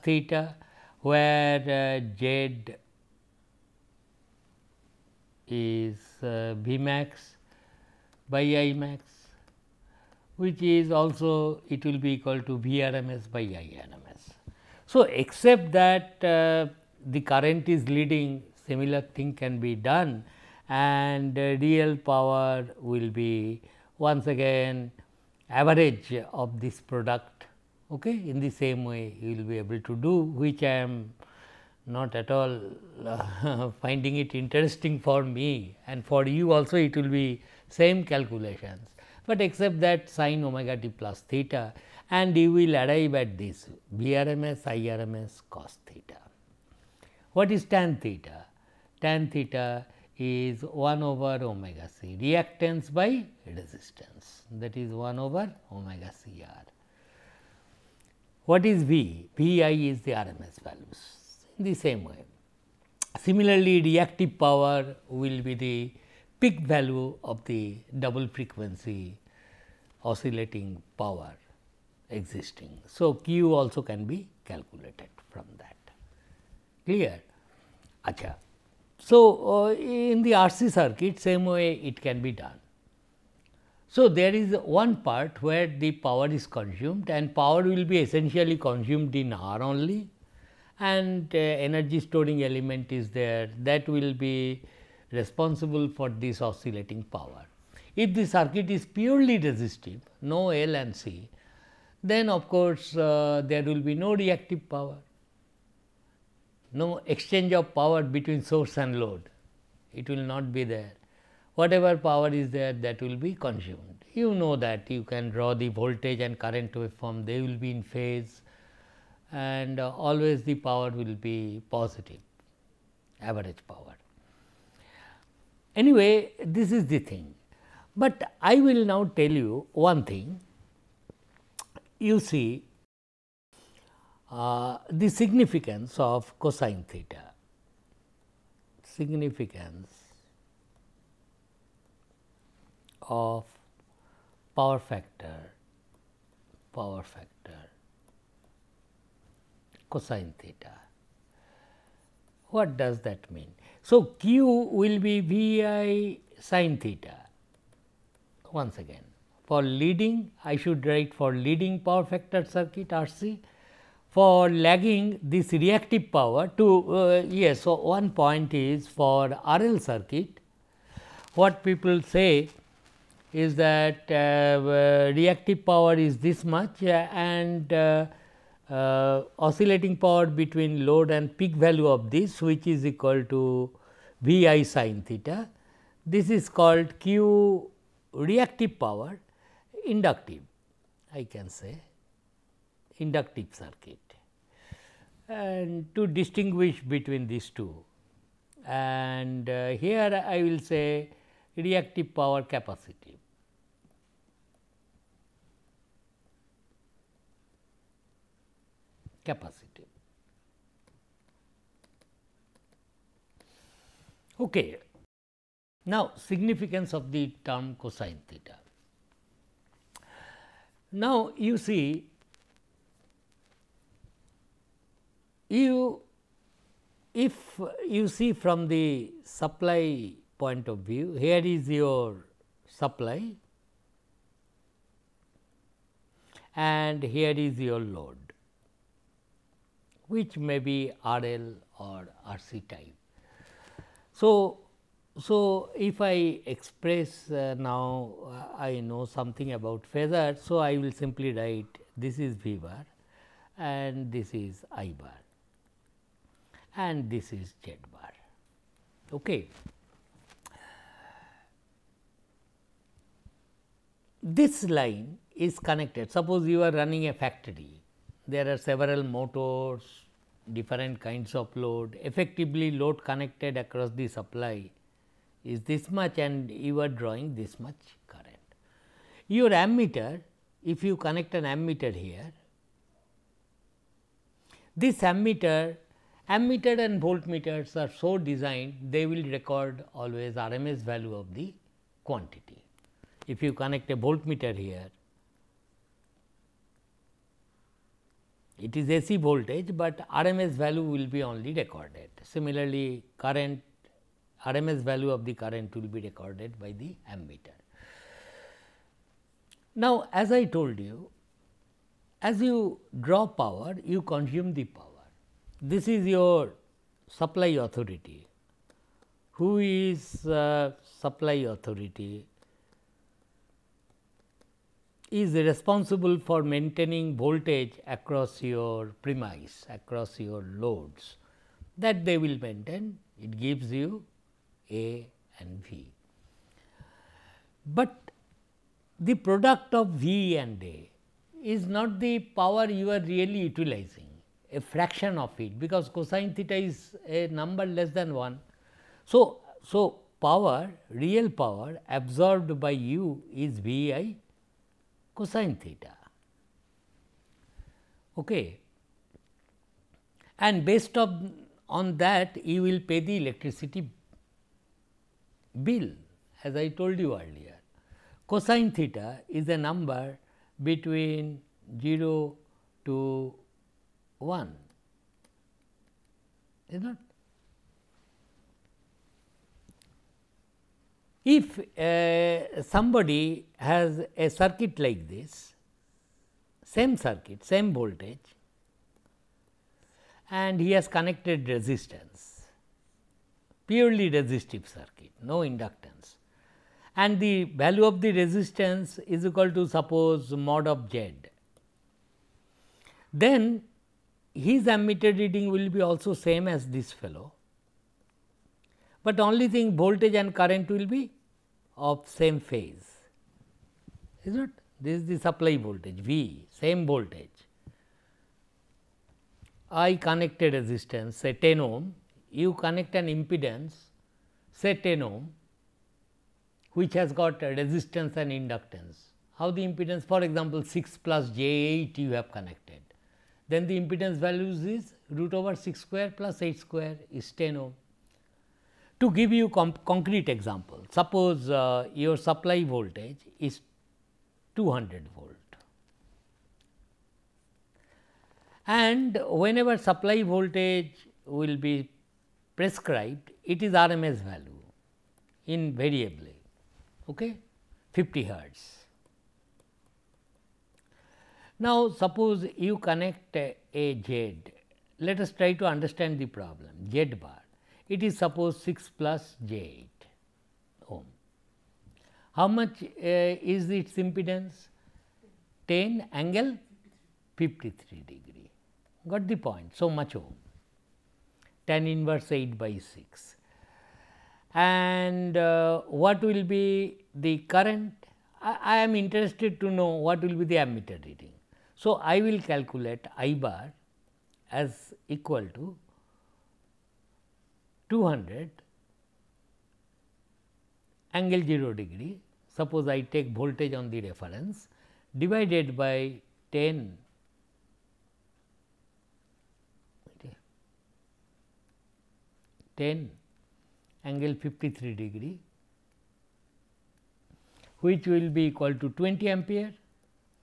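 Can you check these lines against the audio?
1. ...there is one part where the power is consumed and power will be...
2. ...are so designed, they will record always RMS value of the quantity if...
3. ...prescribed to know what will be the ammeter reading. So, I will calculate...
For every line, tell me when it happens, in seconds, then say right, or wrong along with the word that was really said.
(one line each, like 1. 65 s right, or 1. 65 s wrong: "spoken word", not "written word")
1. 84 s right
2. 287 s right
3. 488 s wrong: "interested", not "prescribed".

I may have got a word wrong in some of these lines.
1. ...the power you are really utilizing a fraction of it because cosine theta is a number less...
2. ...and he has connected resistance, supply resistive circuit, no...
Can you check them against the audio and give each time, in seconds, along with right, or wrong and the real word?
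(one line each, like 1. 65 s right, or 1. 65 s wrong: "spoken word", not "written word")
1. 341 s right
2. 390 s wrong: "purely", not "supply".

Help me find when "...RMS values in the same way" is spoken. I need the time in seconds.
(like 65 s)
60 s.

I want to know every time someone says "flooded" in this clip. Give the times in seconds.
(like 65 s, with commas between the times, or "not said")
not said.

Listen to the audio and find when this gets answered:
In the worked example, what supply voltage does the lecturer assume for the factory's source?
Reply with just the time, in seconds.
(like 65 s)
444 s.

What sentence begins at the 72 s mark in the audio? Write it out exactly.
So, Q also can be calculated from that.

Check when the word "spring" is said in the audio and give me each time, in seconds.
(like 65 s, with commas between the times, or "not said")
not said.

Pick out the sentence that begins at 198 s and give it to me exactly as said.
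And uh, here I will say reactive power capacity.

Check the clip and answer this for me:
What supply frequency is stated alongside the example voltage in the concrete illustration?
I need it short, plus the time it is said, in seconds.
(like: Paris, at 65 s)
50 hertz, at 457 s.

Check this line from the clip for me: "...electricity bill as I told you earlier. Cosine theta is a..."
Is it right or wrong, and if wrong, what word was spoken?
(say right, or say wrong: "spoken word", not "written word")
right.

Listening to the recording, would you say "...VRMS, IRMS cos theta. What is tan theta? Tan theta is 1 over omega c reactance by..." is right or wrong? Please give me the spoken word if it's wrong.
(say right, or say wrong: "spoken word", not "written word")
right.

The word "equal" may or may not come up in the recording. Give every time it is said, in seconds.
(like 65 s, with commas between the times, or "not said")
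12 s, 182 s, 399 s, 495 s, 518 s.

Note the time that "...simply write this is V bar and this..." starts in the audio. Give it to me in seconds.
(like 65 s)
250 s.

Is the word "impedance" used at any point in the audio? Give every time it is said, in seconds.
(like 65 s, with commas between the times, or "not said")
423 s, 429 s, 433 s, 474 s.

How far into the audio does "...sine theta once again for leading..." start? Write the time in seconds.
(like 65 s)
156 s.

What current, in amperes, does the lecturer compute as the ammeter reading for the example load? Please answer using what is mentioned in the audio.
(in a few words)
20 ampere.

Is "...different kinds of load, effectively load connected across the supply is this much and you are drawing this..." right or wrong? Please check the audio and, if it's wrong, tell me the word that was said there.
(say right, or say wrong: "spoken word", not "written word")
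right.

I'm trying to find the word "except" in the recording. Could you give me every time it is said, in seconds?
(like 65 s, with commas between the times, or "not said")
15 s, 39 s.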